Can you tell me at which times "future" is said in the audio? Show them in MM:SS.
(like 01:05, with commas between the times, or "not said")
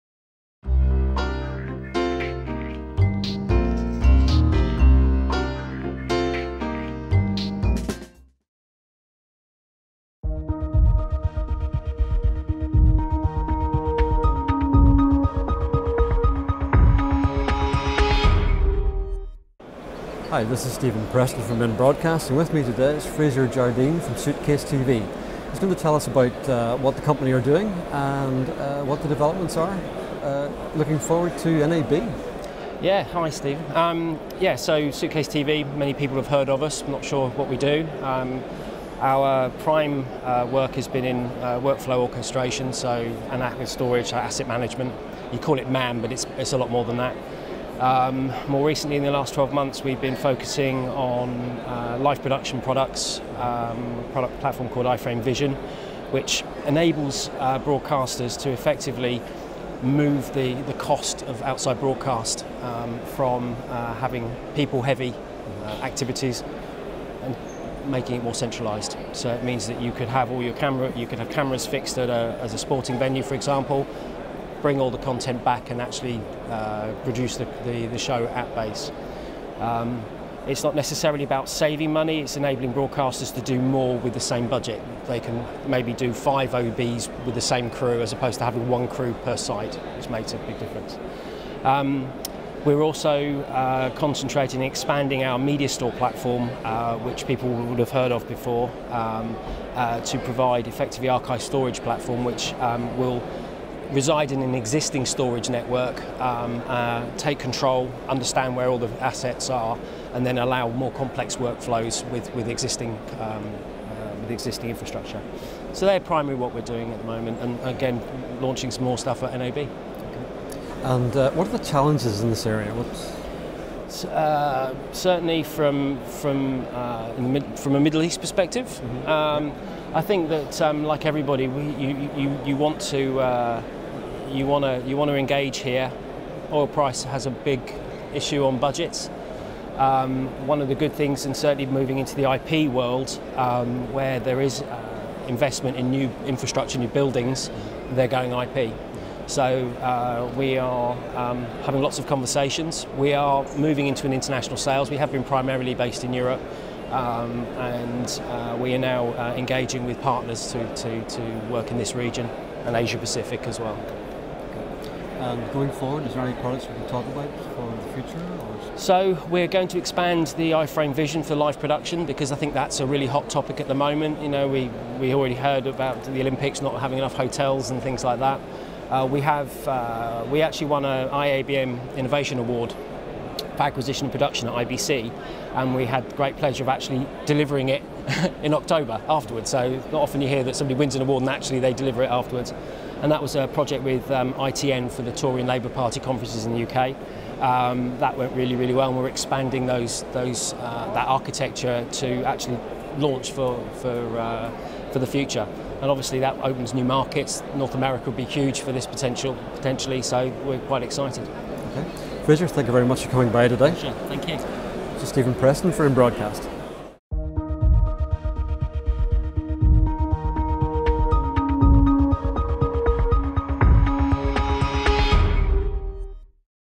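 02:47, 03:25.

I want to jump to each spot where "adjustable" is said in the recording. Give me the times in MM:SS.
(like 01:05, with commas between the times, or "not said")
not said.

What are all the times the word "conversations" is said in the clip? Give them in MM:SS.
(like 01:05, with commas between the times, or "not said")
02:32.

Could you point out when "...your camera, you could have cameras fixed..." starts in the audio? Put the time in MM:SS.
01:10.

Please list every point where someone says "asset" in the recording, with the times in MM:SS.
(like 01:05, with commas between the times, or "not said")
00:44, 01:49.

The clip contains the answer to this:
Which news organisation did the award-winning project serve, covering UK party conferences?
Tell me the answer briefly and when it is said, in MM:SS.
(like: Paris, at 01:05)
ITN, at 03:14.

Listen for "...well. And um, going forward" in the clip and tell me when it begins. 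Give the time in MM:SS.
02:43.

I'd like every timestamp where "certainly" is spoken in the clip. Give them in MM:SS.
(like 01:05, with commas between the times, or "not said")
02:04, 02:21.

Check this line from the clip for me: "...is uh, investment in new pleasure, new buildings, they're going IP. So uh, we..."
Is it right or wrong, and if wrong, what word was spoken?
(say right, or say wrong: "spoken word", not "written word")
wrong: "infrastructure", not "pleasure".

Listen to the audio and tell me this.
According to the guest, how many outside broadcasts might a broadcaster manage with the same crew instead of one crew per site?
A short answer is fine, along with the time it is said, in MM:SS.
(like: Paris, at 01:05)
5, at 01:26.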